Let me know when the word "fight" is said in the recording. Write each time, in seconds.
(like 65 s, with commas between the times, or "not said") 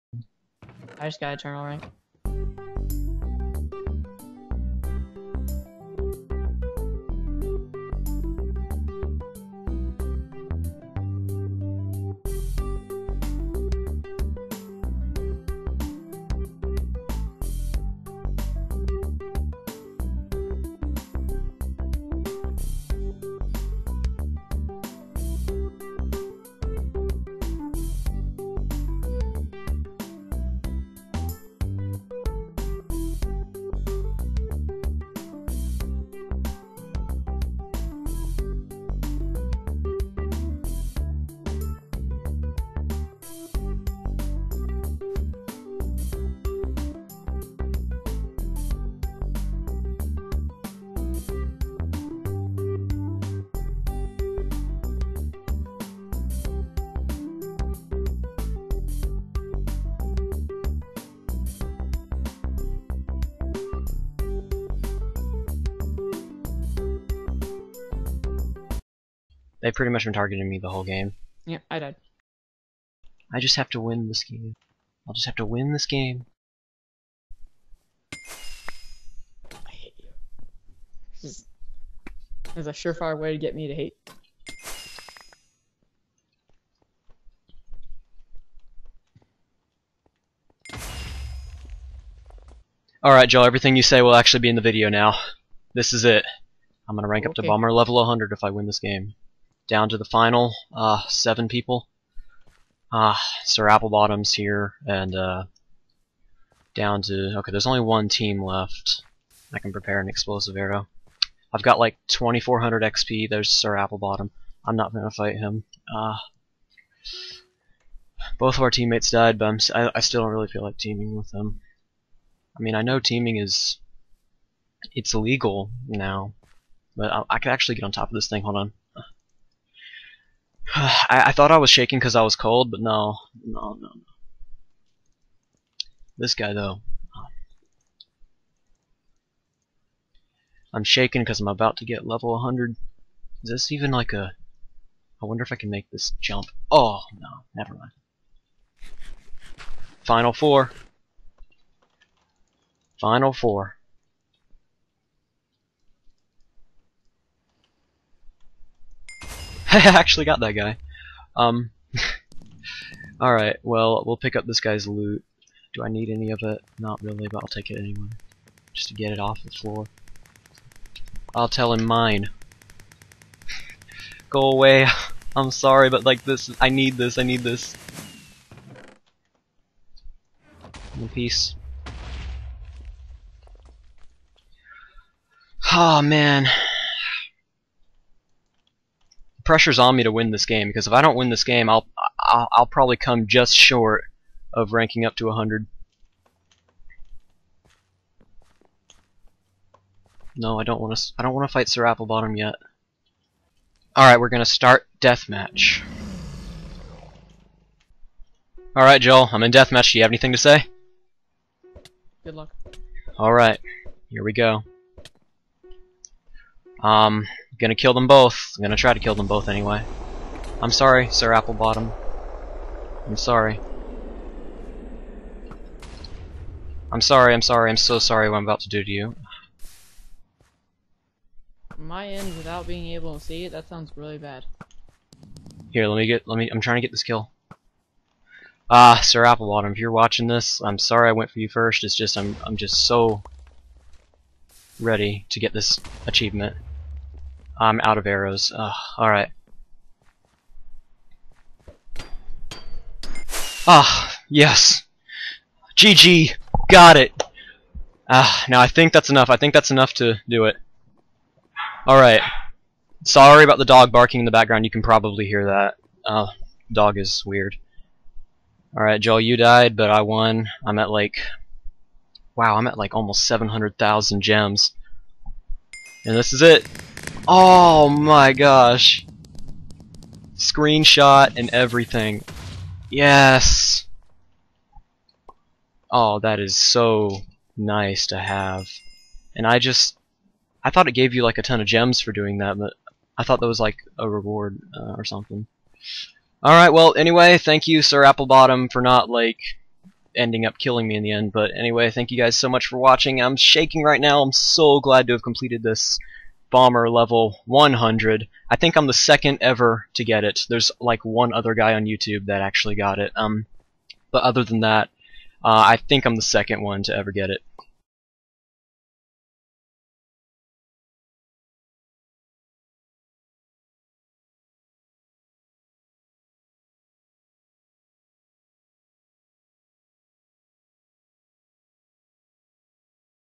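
115 s, 201 s.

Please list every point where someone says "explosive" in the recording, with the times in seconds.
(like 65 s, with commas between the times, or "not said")
110 s.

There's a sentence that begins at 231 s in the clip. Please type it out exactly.
My end without being able to see it, that sounds really bad.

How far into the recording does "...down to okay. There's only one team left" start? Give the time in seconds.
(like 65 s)
106 s.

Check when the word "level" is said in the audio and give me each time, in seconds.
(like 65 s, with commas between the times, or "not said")
97 s, 142 s, 306 s.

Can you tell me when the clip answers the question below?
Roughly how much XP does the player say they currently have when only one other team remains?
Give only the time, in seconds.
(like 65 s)
112 s.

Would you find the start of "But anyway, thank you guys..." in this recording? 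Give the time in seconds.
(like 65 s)
301 s.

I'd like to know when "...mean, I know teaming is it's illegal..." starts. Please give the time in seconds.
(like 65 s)
122 s.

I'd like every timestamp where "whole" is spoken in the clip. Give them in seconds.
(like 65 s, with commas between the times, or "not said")
70 s.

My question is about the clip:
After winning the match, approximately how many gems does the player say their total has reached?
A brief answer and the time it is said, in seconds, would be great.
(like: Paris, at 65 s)
700,000, at 273 s.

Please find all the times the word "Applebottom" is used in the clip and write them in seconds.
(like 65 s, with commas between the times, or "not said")
103 s, 113 s, 201 s, 221 s, 239 s, 298 s.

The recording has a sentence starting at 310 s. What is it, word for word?
There's like one other guy on YouTube that actually got it.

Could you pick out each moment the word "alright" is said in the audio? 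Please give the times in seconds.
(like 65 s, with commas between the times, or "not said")
93 s, 163 s, 248 s, 261 s, 268 s, 296 s.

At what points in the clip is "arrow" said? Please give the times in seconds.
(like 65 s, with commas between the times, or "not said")
110 s, 248 s.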